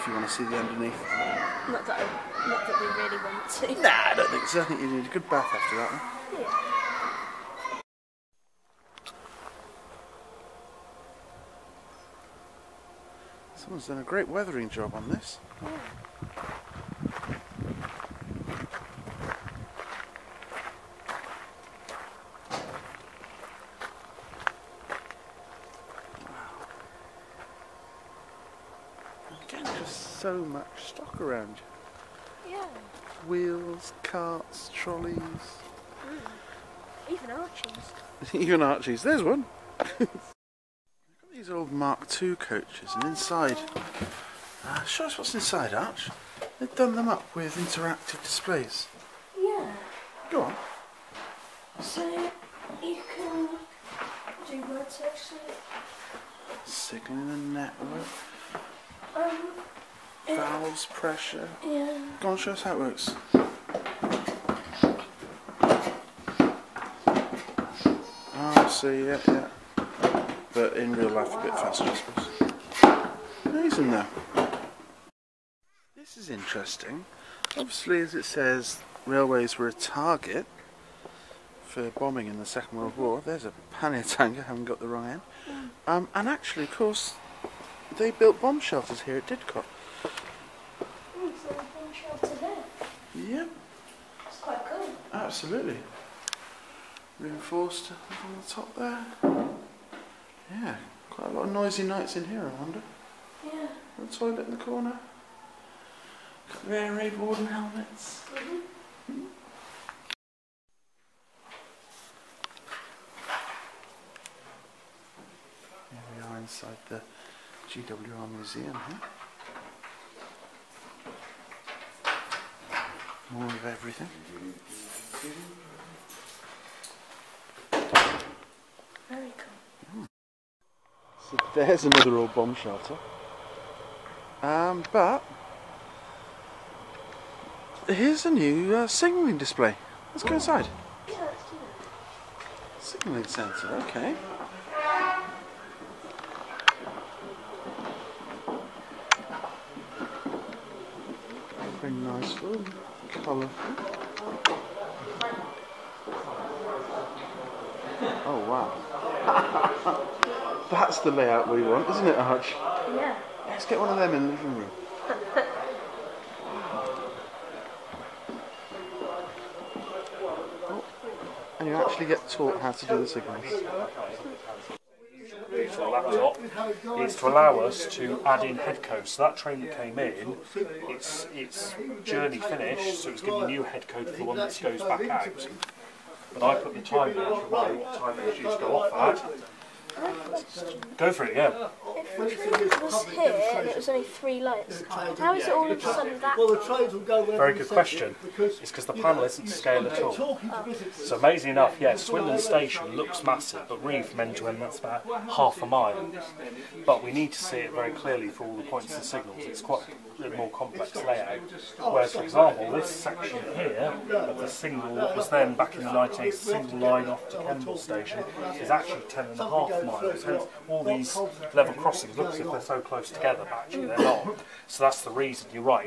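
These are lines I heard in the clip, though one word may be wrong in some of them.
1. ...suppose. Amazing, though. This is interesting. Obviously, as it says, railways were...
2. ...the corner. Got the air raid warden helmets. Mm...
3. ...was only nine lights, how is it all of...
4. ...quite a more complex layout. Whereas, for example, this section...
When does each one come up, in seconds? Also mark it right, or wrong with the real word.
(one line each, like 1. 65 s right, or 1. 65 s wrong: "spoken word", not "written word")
1. 71 s right
2. 104 s right
3. 193 s wrong: "three", not "nine"
4. 209 s right.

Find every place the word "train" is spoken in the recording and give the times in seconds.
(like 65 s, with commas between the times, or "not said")
179 s, 196 s.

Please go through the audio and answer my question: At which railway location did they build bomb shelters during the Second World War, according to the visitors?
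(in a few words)
Didcot.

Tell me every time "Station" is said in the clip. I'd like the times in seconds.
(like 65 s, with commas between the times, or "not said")
202 s, 217 s.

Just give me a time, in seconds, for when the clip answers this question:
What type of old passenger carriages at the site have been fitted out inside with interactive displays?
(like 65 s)
41 s.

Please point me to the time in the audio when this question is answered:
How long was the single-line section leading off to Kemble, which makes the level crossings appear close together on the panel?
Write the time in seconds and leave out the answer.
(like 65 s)
219 s.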